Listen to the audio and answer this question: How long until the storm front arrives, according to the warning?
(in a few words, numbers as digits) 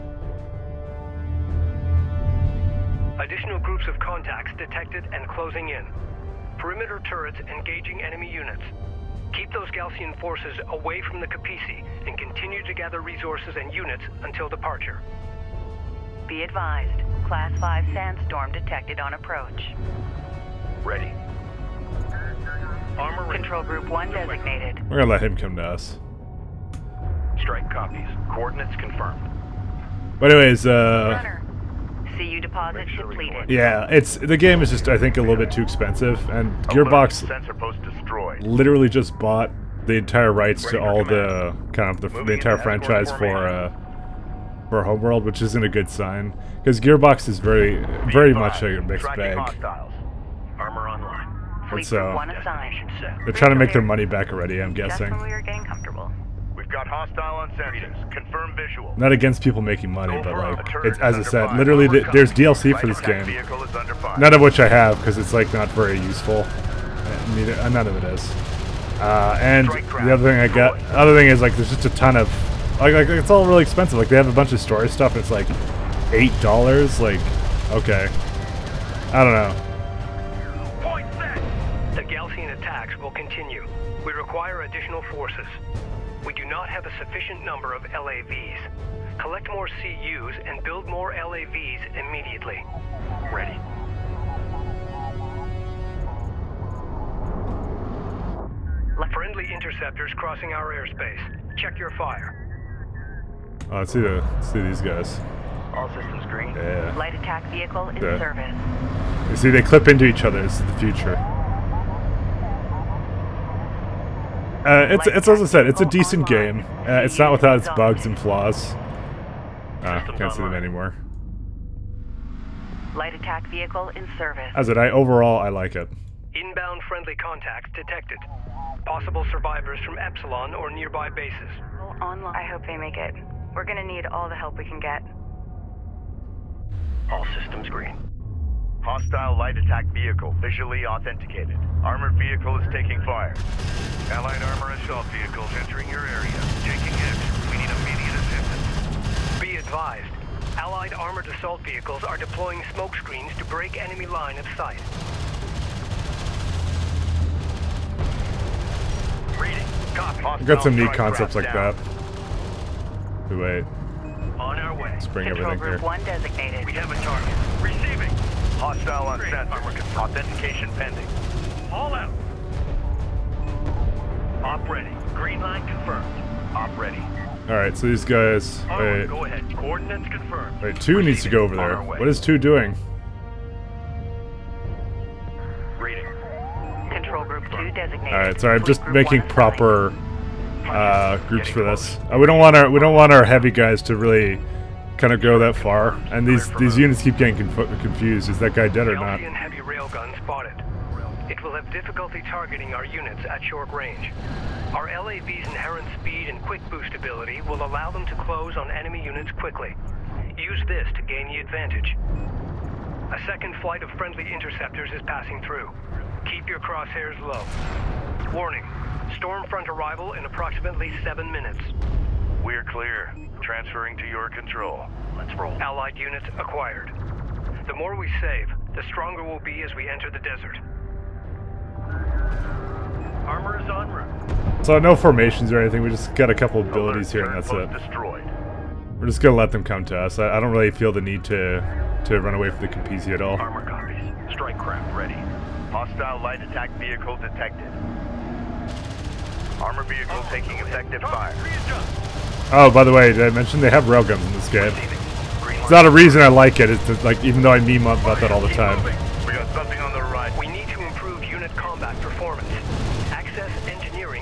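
7 minutes.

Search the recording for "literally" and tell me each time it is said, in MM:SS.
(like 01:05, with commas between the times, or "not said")
00:38, 01:01.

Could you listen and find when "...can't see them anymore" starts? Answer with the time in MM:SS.
02:00.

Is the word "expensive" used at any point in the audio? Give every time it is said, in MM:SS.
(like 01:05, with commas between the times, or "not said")
00:35, 01:13.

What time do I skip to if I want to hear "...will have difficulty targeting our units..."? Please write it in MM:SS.
03:21.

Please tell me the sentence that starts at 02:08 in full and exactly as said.
Possible survivors from Epsilon or nearby bases.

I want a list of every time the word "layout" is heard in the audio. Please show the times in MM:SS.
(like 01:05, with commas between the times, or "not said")
not said.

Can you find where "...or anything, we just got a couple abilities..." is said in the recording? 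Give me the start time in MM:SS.
03:55.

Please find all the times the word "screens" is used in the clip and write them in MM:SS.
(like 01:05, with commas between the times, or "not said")
02:32.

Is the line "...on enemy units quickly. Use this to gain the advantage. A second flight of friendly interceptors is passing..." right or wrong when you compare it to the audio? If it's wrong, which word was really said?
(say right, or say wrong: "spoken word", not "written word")
right.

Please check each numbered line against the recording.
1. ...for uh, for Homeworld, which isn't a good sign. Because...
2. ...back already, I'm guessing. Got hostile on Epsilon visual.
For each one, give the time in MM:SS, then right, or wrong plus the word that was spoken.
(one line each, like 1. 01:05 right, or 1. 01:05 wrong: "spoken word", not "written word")
1. 00:43 right
2. 00:54 wrong: "Confirm", not "Epsilon".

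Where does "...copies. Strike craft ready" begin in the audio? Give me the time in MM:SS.
04:03.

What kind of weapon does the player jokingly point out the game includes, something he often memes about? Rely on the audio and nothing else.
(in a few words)
railguns.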